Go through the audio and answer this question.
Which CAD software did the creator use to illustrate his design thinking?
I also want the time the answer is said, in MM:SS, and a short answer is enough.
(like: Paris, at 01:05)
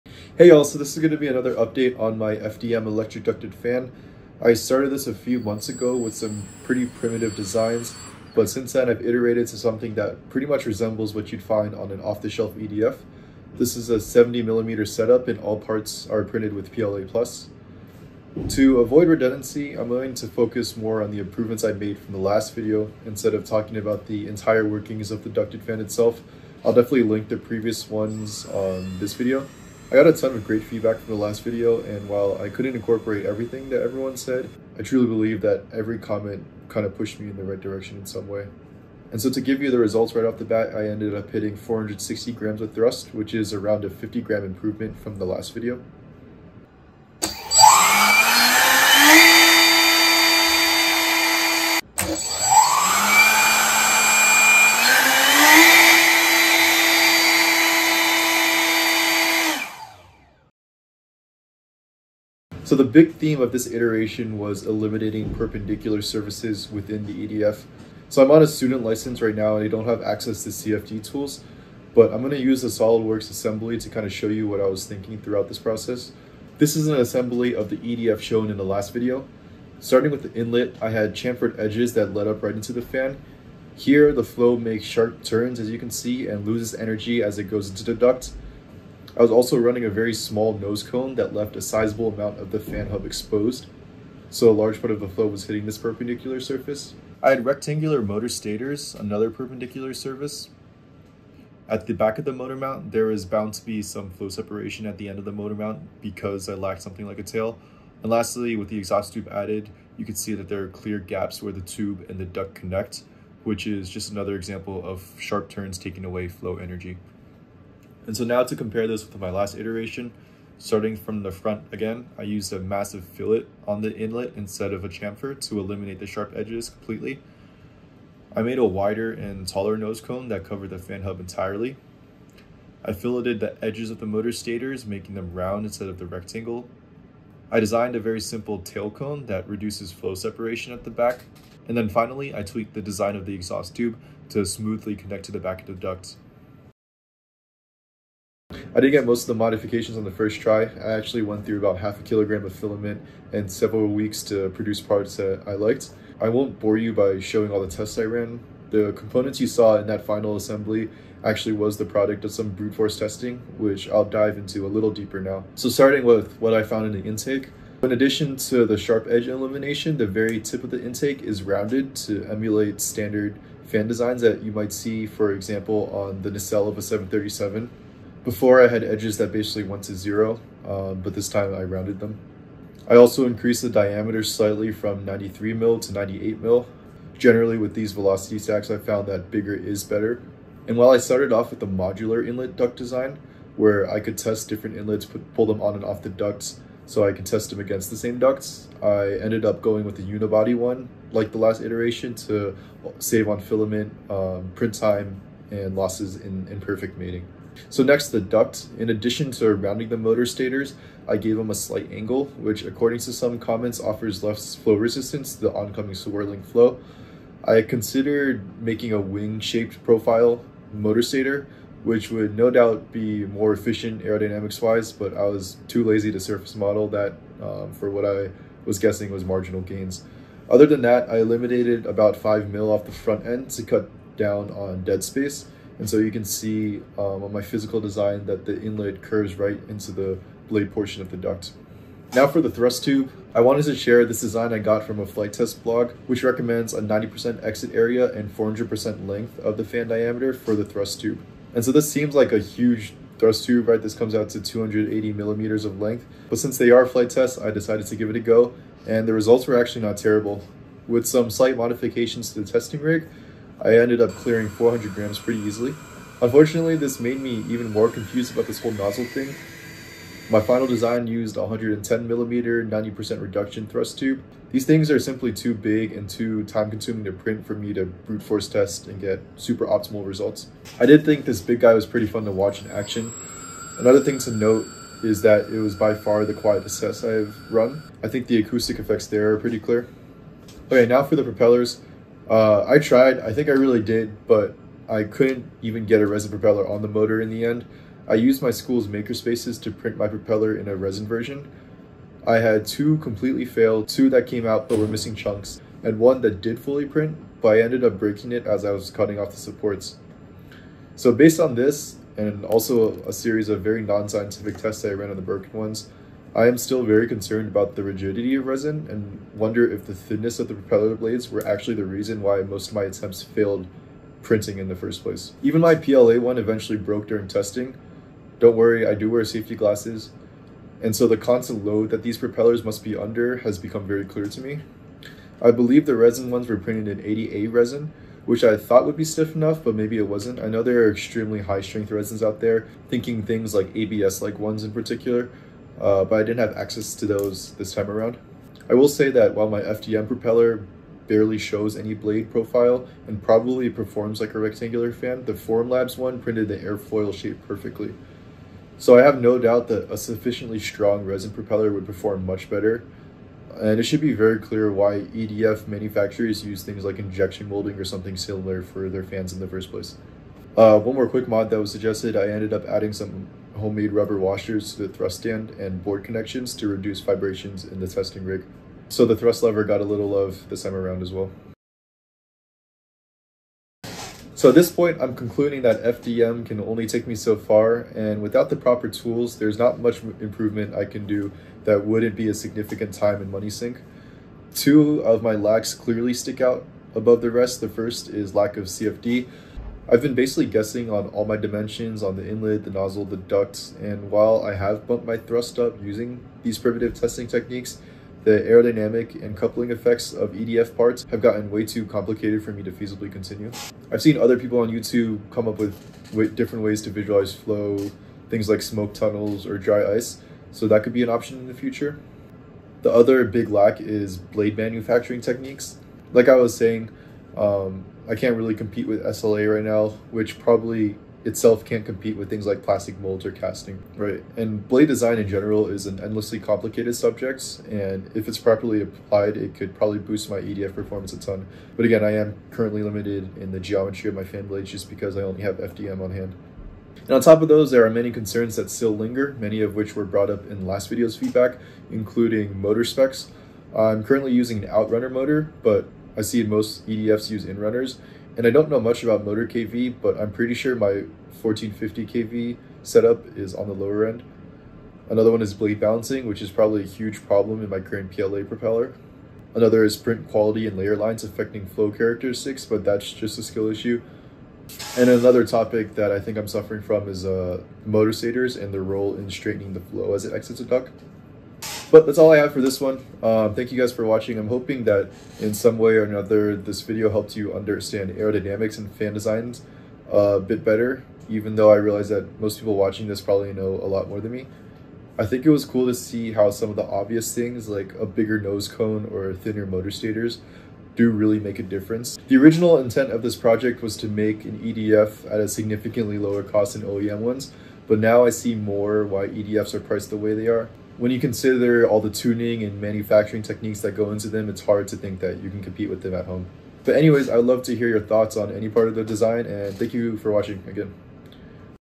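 SOLIDWORKS, at 01:12.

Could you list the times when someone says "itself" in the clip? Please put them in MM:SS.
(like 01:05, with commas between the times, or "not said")
00:25, 07:11.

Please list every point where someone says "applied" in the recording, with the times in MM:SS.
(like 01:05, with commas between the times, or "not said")
07:18.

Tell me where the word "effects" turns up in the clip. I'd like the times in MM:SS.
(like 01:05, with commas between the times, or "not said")
04:48, 06:49.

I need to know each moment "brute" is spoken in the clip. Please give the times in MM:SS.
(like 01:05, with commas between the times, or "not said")
02:42, 04:37.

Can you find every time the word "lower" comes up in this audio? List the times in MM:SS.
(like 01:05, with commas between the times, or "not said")
07:43, 08:26.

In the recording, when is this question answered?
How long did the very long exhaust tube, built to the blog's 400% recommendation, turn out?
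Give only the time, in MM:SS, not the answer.
04:14.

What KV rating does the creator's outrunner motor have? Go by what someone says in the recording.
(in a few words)
1450 KV.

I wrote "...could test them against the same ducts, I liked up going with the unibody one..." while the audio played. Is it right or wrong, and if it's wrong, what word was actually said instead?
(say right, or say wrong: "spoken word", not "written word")
wrong: "ended", not "liked".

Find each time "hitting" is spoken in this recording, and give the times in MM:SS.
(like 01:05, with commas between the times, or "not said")
00:41, 01:35.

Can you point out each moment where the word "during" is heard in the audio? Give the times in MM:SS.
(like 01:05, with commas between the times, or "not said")
05:27.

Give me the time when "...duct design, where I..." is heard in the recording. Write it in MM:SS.
03:12.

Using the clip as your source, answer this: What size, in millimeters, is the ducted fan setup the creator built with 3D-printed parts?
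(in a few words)
70 millimeter.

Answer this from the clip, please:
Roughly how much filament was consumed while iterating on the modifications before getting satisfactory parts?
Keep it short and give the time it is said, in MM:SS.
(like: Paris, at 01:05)
half a kilogram, at 02:31.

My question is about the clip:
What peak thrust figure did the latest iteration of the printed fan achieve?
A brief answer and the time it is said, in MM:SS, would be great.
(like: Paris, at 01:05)
460 grams, at 00:41.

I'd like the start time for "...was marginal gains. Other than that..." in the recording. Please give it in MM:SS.
03:49.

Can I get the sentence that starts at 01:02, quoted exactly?
So the big theme of this iteration was eliminating perpendicular surfaces within the EDF.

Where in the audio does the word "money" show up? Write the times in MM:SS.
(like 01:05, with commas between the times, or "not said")
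06:33.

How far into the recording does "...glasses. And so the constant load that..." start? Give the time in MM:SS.
05:29.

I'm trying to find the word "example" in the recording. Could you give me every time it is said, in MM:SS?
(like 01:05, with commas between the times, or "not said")
01:54, 02:55.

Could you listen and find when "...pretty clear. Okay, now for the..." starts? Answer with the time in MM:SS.
04:49.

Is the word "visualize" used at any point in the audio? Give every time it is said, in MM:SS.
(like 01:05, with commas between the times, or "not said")
06:56.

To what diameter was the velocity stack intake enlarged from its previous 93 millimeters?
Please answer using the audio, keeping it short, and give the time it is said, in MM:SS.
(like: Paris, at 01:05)
98 mm, at 03:05.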